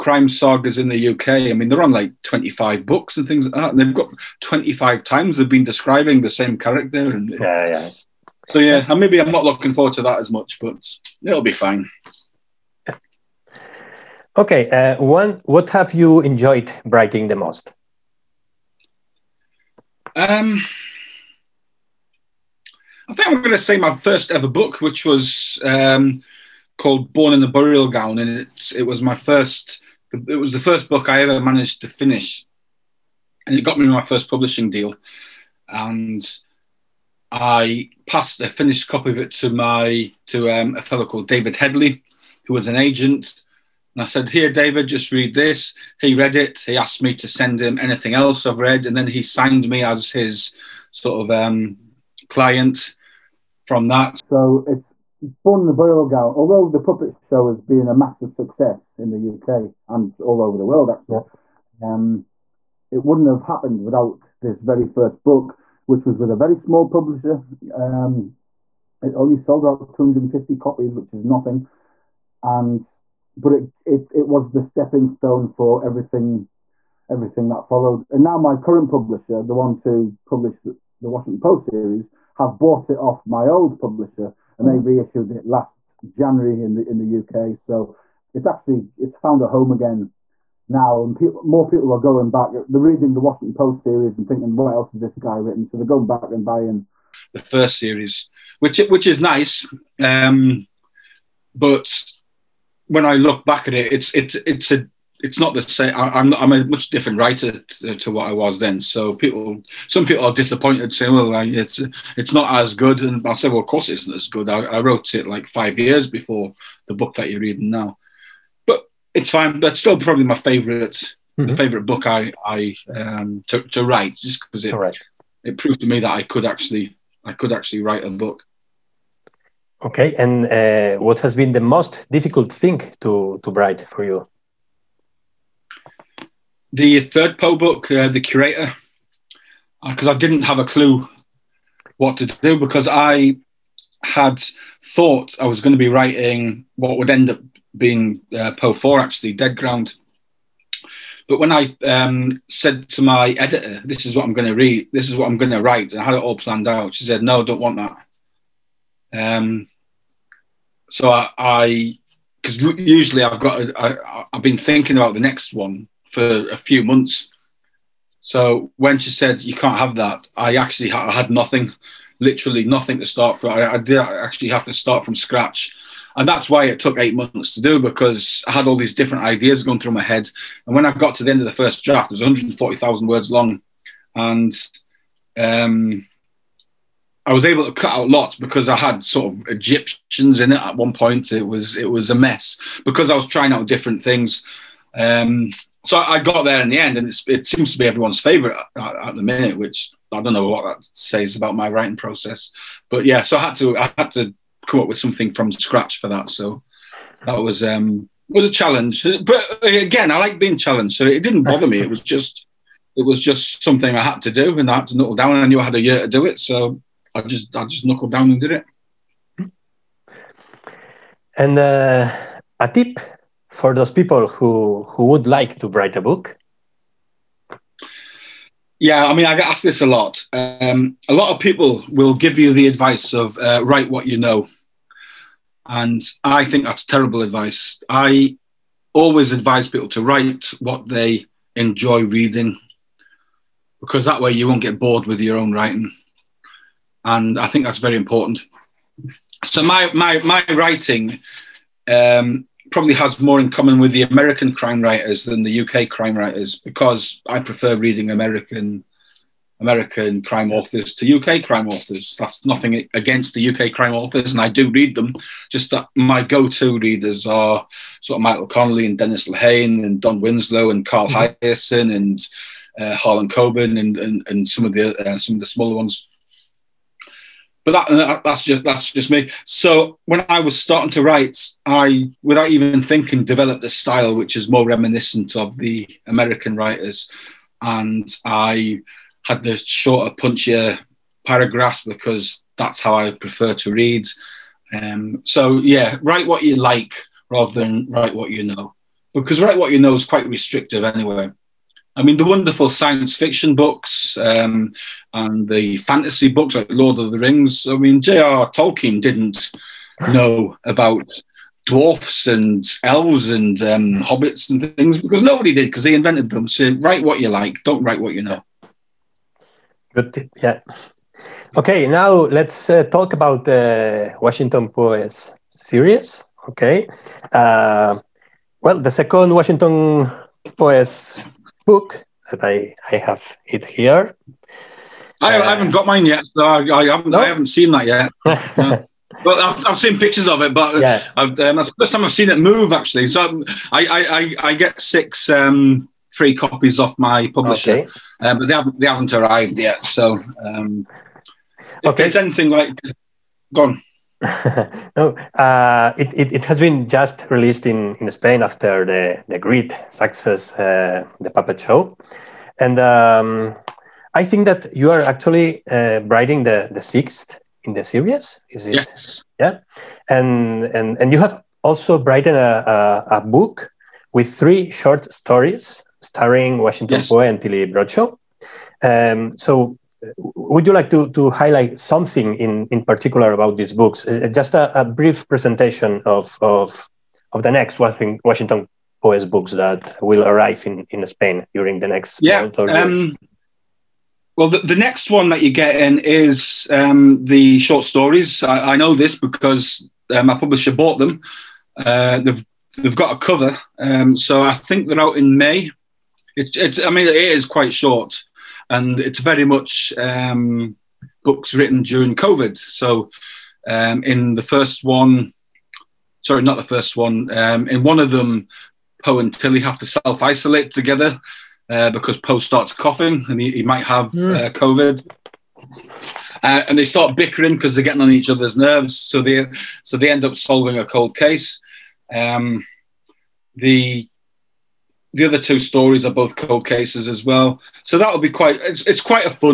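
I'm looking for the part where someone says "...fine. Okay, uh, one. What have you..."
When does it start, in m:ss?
0:11.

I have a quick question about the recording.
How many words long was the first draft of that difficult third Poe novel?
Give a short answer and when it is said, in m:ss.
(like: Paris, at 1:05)
140,000, at 3:02.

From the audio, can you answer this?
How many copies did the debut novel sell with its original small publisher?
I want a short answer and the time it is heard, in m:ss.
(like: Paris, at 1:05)
250, at 1:09.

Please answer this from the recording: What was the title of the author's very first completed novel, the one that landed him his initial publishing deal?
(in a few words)
Born in a Burial Gown.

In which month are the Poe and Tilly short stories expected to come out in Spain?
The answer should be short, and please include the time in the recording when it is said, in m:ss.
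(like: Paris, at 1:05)
May, at 6:45.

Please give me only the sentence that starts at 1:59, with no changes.
That's still probably my favorite, mm-hmm.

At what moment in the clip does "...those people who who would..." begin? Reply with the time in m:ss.
3:43.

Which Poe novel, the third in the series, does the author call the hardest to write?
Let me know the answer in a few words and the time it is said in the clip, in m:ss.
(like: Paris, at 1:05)
The Curator, at 2:18.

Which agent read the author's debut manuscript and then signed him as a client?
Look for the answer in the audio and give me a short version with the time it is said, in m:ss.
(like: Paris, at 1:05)
David Headley, at 0:41.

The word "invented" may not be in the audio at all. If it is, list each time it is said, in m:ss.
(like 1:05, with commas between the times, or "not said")
5:15.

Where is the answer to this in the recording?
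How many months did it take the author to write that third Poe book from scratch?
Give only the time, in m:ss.
2:56.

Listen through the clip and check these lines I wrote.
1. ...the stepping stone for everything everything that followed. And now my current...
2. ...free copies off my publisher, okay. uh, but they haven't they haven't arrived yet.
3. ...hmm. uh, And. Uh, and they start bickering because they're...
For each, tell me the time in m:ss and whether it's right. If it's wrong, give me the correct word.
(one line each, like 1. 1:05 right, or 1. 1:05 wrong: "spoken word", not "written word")
1. 1:14 right
2. 5:46 right
3. 7:04 wrong: "COVID", not "And".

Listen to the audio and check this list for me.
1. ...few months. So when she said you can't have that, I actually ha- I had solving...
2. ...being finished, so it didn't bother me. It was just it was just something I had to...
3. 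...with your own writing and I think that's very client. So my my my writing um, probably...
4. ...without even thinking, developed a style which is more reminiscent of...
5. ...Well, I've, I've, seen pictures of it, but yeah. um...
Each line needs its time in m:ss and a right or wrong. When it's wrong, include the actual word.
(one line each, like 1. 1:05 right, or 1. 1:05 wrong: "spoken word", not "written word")
1. 2:46 wrong: "nothing", not "solving"
2. 3:30 wrong: "challenged", not "finished"
3. 4:05 wrong: "important", not "client"
4. 4:42 right
5. 5:39 right.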